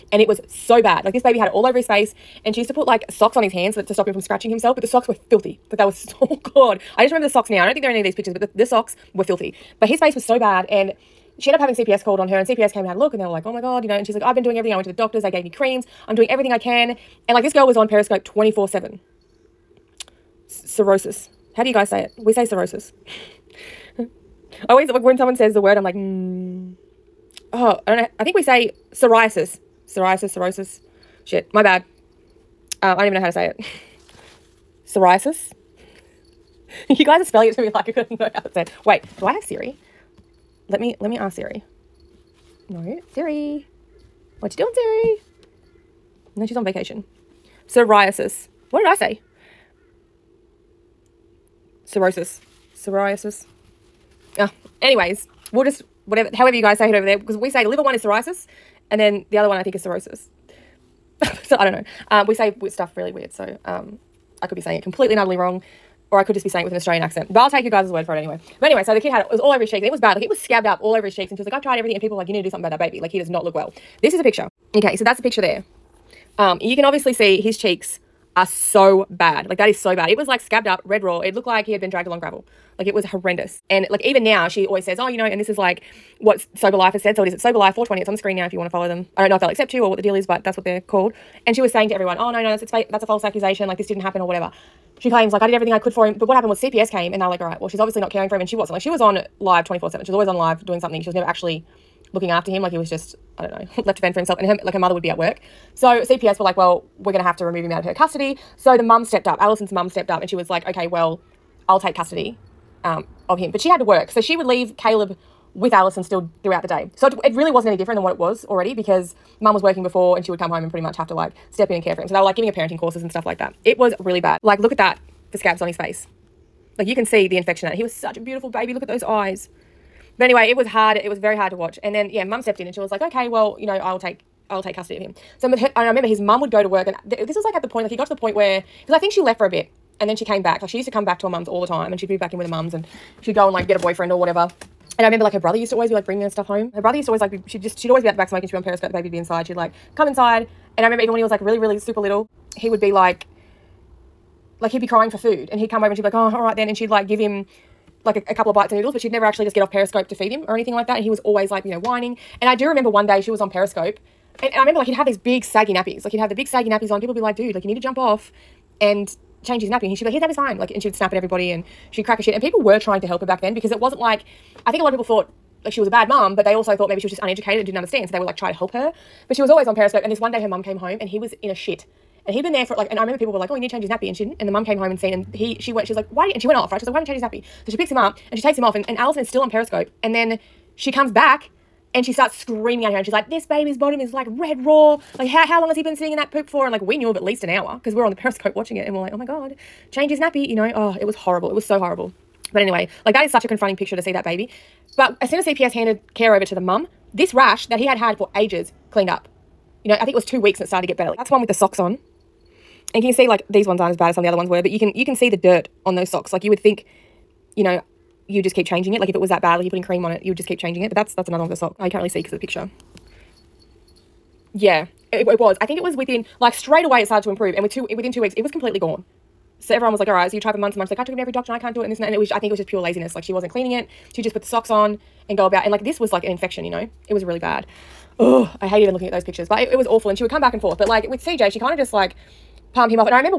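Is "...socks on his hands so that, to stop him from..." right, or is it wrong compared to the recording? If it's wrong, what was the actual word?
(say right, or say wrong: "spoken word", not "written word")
right.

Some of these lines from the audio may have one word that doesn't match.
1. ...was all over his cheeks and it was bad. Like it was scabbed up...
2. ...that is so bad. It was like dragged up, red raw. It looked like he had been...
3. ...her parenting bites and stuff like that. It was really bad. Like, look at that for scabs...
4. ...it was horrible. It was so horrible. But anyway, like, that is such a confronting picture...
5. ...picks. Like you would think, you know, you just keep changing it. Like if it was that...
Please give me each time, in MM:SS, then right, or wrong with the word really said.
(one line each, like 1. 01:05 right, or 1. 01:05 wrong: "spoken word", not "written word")
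1. 01:09 right
2. 01:19 wrong: "scabbed", not "dragged"
3. 02:02 wrong: "courses", not "bites"
4. 03:20 right
5. 03:36 wrong: "socks", not "picks".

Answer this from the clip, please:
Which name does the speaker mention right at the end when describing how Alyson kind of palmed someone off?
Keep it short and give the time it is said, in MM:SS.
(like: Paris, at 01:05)
CJ, at 04:01.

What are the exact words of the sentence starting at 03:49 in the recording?
So everyone was like, "All right." So you try for months and months.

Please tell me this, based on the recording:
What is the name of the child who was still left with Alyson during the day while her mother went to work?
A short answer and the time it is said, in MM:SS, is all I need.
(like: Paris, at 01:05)
Caleb, at 01:54.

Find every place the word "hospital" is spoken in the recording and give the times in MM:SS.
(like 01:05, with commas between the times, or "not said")
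not said.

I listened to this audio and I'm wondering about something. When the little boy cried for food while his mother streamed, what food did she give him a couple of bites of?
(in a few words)
noodles.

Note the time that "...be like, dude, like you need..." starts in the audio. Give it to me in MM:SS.
02:47.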